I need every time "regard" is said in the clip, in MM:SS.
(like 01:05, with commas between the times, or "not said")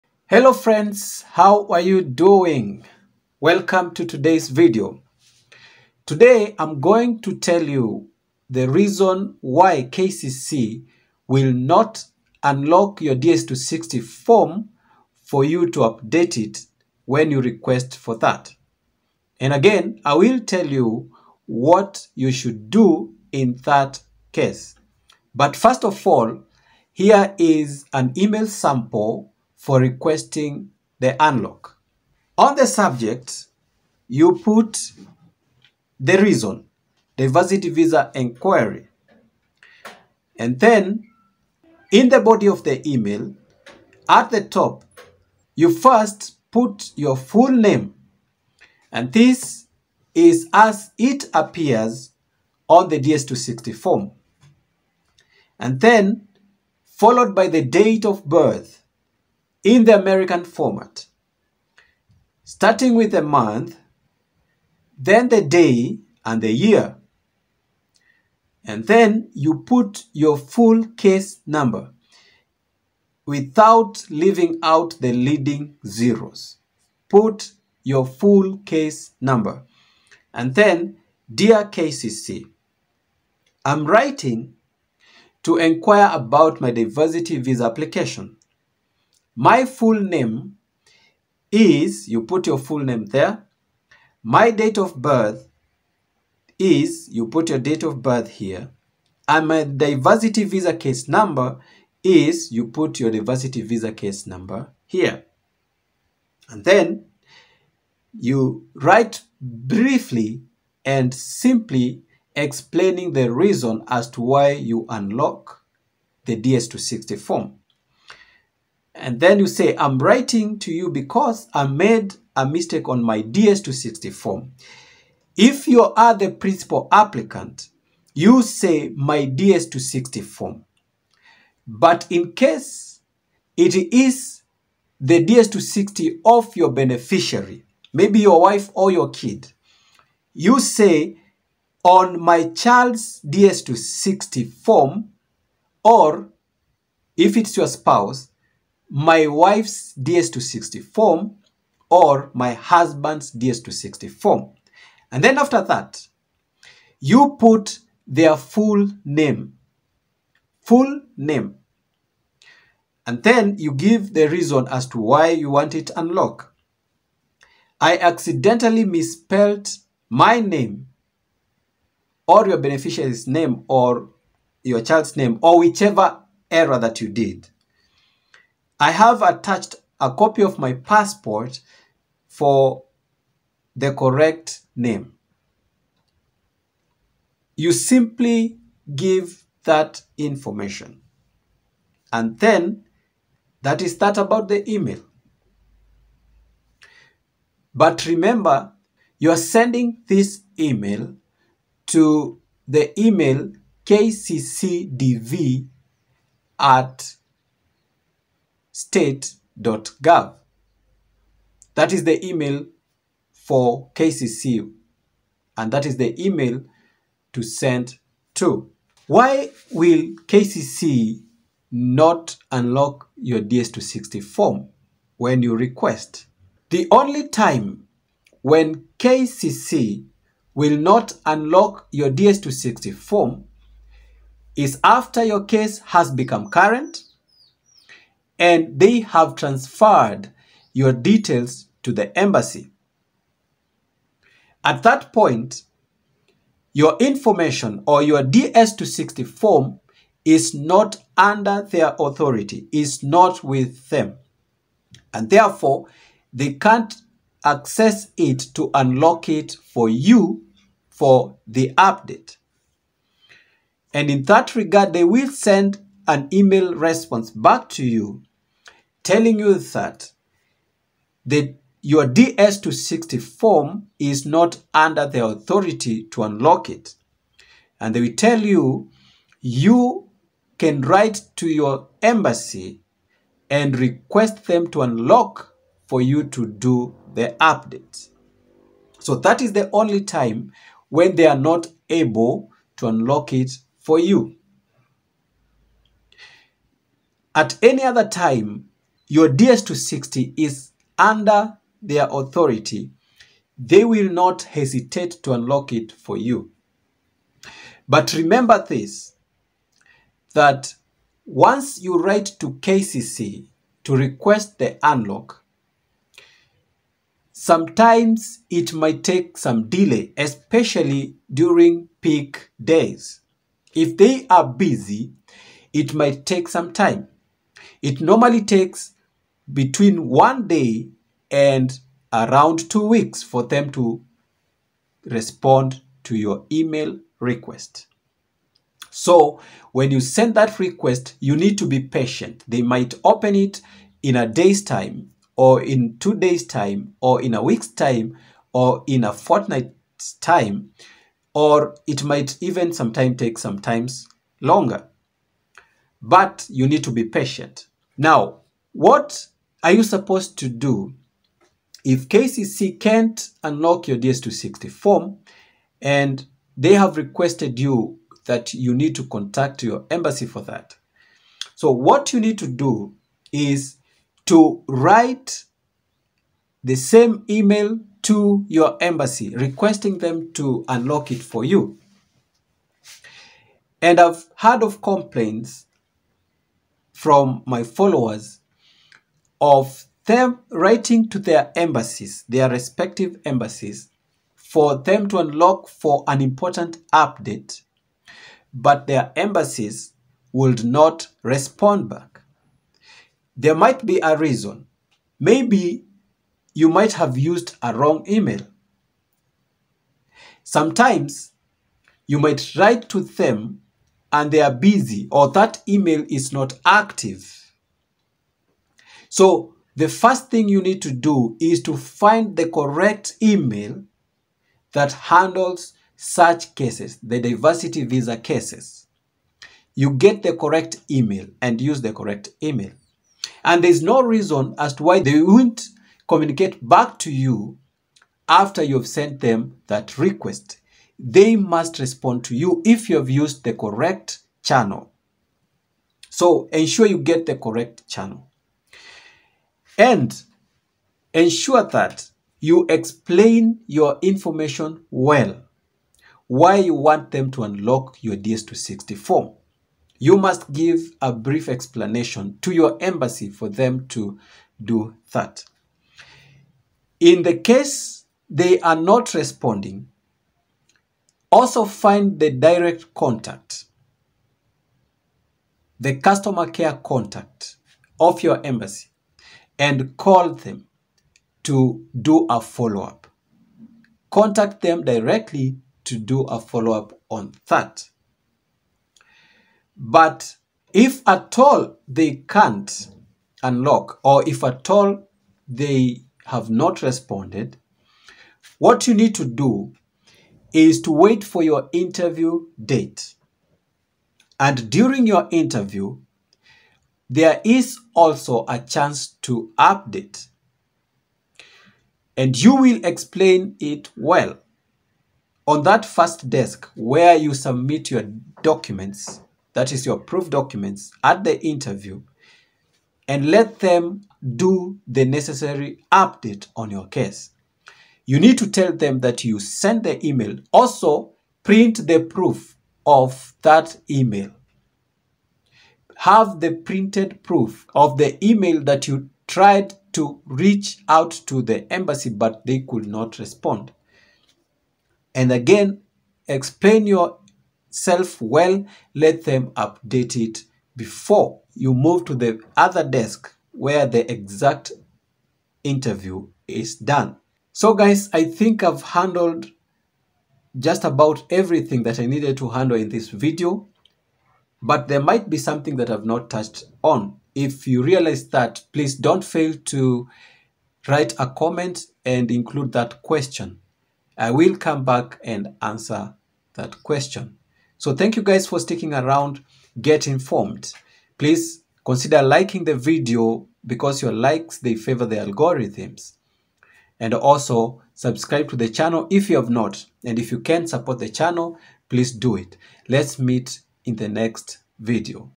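04:24.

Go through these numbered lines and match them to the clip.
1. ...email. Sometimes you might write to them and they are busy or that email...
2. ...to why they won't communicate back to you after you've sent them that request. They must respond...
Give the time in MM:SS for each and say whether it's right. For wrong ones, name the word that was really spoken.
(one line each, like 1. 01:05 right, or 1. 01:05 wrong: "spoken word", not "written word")
1. 06:48 right
2. 07:14 right.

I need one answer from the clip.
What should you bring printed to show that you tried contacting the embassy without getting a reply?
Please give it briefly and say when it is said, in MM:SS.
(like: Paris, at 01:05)
Proof of the email, at 08:52.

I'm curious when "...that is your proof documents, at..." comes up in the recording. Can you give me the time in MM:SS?
08:39.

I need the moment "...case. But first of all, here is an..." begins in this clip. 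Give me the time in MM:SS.
00:24.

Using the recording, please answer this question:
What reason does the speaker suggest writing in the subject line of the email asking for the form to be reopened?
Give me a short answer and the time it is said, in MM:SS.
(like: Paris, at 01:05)
Diversity visa inquiry, at 00:37.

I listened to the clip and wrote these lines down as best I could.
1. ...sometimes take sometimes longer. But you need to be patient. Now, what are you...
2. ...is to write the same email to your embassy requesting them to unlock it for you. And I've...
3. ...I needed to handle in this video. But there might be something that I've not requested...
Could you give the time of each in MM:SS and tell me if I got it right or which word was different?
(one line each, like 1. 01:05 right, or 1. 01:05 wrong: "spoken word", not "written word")
1. 05:52 right
2. 06:13 right
3. 09:21 wrong: "touched", not "requested".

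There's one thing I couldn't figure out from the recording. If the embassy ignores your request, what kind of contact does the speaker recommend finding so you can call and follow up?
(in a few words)
Customer care contact.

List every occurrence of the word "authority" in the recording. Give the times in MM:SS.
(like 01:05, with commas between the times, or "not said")
04:11, 04:35, 05:02.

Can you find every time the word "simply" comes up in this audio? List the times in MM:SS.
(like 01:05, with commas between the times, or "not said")
01:51, 03:07.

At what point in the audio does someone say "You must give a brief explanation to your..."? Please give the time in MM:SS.
07:39.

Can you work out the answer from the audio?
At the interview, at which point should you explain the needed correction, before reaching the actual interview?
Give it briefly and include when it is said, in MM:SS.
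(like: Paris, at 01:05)
First desk, at 08:35.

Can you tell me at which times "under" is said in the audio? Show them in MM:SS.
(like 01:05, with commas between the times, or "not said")
04:11, 04:34, 05:00.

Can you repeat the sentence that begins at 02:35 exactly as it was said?
And then after that, you put their full name.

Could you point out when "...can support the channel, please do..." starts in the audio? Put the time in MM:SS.
09:50.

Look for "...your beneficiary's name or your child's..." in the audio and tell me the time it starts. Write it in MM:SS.
02:52.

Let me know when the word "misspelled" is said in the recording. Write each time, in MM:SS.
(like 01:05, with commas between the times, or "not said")
02:48.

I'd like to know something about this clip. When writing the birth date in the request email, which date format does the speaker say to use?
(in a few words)
American format.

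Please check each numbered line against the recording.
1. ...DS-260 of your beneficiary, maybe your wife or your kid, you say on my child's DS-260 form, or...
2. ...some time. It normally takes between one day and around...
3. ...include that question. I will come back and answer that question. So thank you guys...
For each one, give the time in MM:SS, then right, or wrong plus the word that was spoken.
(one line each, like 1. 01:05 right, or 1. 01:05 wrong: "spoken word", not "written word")
1. 02:15 right
2. 05:26 right
3. 09:32 right.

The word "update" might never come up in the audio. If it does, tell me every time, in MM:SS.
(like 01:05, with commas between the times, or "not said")
00:15, 04:21, 04:47, 06:36, 08:29, 08:45, 09:09.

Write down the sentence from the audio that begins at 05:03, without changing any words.
They will not hesitate to unlock it for you.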